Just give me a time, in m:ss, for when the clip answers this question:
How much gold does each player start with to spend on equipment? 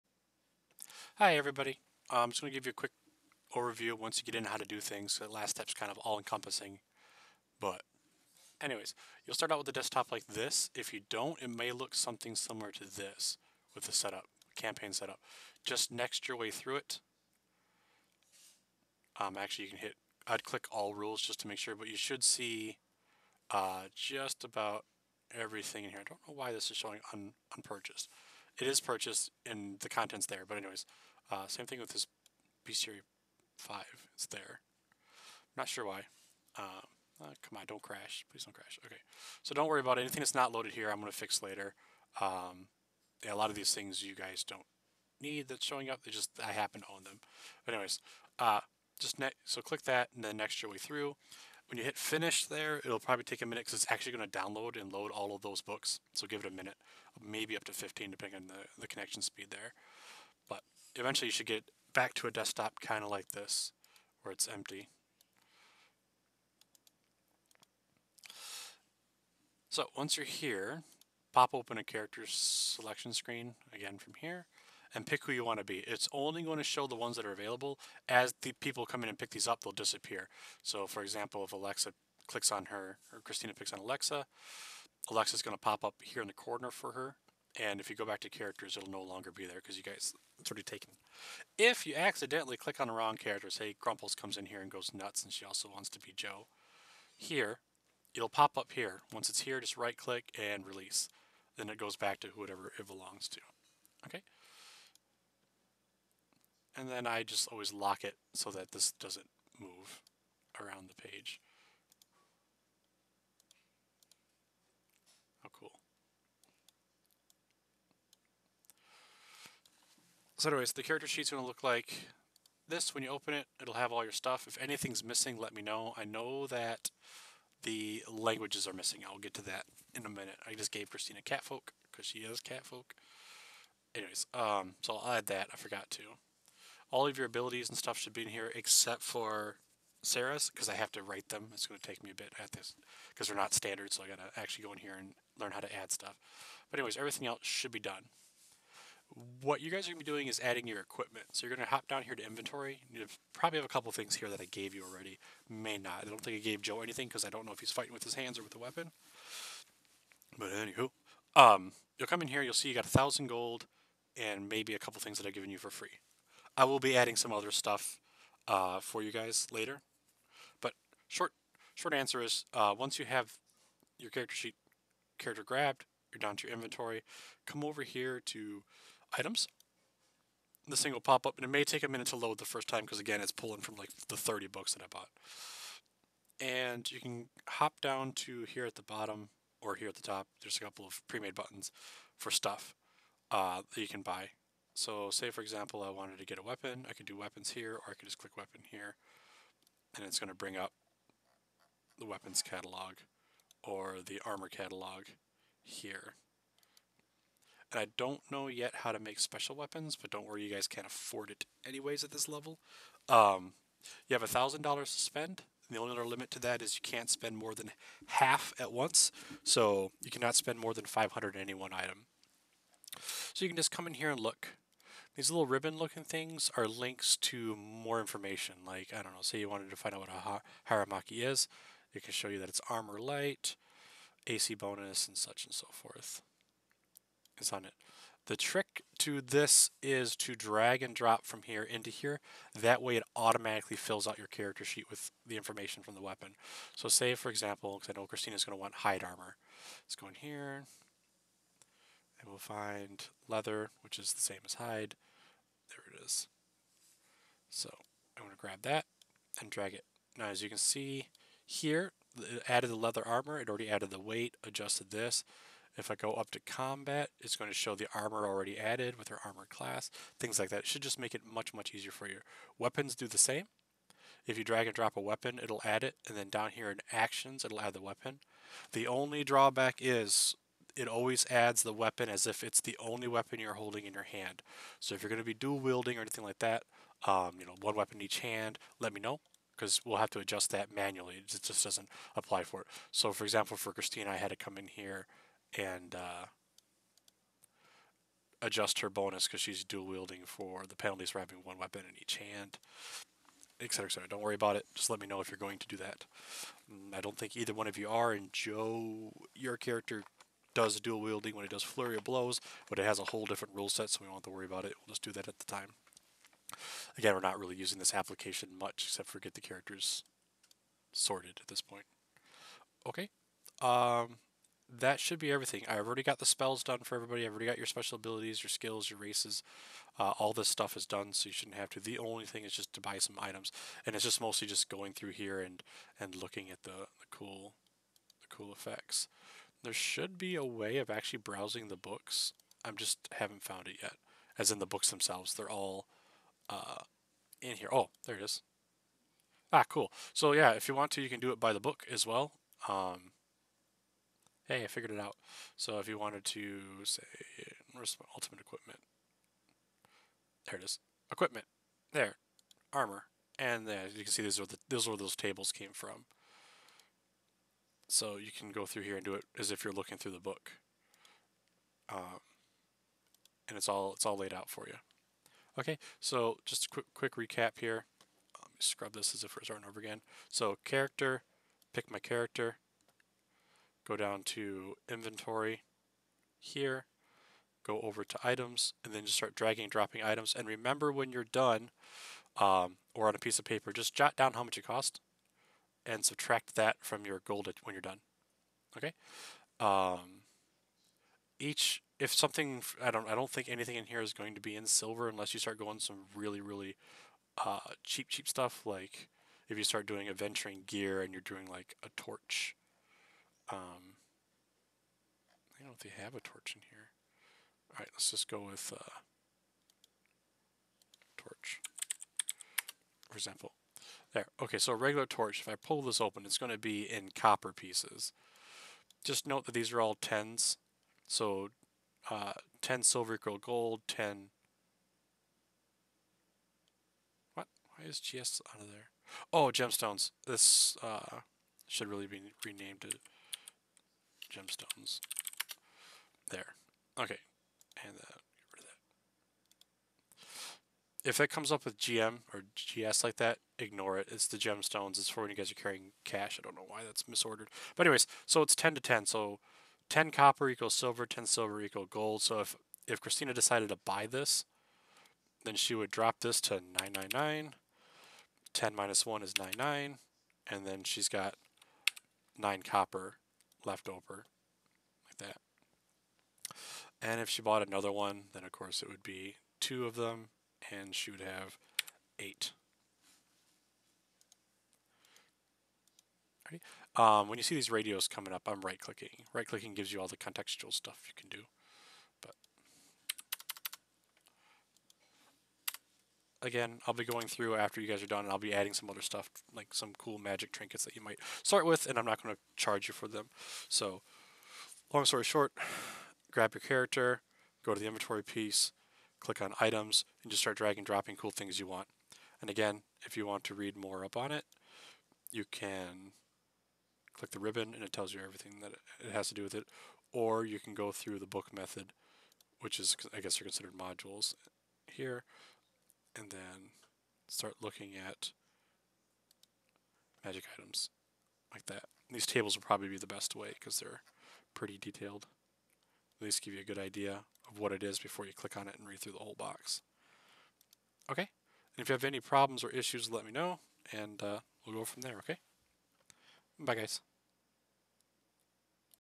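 2:42.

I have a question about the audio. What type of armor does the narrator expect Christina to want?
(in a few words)
hide armor.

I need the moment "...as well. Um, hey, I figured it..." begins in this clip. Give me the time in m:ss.
5:51.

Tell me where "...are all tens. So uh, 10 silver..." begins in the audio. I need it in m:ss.
7:09.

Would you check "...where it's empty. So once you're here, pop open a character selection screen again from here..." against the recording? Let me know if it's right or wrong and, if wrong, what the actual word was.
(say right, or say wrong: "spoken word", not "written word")
right.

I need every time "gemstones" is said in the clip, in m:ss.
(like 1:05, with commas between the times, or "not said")
7:19, 7:24, 7:34.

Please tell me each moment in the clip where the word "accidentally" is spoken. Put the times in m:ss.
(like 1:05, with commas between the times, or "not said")
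1:31.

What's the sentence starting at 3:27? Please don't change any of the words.
And I don't know yet how to make special weapons, but don't worry, you guys can't afford it anyways at this level.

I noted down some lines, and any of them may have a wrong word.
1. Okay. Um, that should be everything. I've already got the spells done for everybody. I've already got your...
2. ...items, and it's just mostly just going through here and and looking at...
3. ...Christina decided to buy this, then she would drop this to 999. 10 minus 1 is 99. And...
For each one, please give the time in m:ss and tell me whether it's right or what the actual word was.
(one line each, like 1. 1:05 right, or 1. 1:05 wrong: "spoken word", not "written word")
1. 5:22 right
2. 5:33 right
3. 7:43 right.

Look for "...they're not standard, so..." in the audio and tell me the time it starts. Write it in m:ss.
2:23.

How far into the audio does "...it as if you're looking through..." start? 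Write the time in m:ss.
6:09.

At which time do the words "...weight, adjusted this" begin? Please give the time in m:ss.
4:23.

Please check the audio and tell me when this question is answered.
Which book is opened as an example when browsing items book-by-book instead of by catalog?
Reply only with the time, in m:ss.
5:58.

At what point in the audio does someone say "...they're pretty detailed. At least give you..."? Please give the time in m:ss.
8:53.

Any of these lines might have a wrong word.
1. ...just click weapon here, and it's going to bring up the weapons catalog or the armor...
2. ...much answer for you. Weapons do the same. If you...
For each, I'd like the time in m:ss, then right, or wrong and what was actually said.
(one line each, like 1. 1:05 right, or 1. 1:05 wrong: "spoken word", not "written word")
1. 3:18 right
2. 4:31 wrong: "easier", not "answer".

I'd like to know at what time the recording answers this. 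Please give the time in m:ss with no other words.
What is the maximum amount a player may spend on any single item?
3:40.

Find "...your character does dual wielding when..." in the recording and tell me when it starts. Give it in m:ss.
5:09.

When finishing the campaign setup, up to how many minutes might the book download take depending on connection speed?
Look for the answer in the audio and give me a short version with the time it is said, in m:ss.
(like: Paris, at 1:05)
15, at 0:57.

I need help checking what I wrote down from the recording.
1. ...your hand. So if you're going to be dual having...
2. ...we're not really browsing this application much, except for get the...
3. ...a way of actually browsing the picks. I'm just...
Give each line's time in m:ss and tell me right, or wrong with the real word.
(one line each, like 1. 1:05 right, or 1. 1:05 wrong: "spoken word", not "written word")
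1. 4:43 wrong: "wielding", not "having"
2. 5:17 wrong: "using", not "browsing"
3. 5:40 wrong: "books", not "picks".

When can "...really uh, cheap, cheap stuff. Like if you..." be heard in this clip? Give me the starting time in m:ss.
6:46.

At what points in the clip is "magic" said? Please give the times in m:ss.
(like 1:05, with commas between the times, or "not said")
8:20, 8:50.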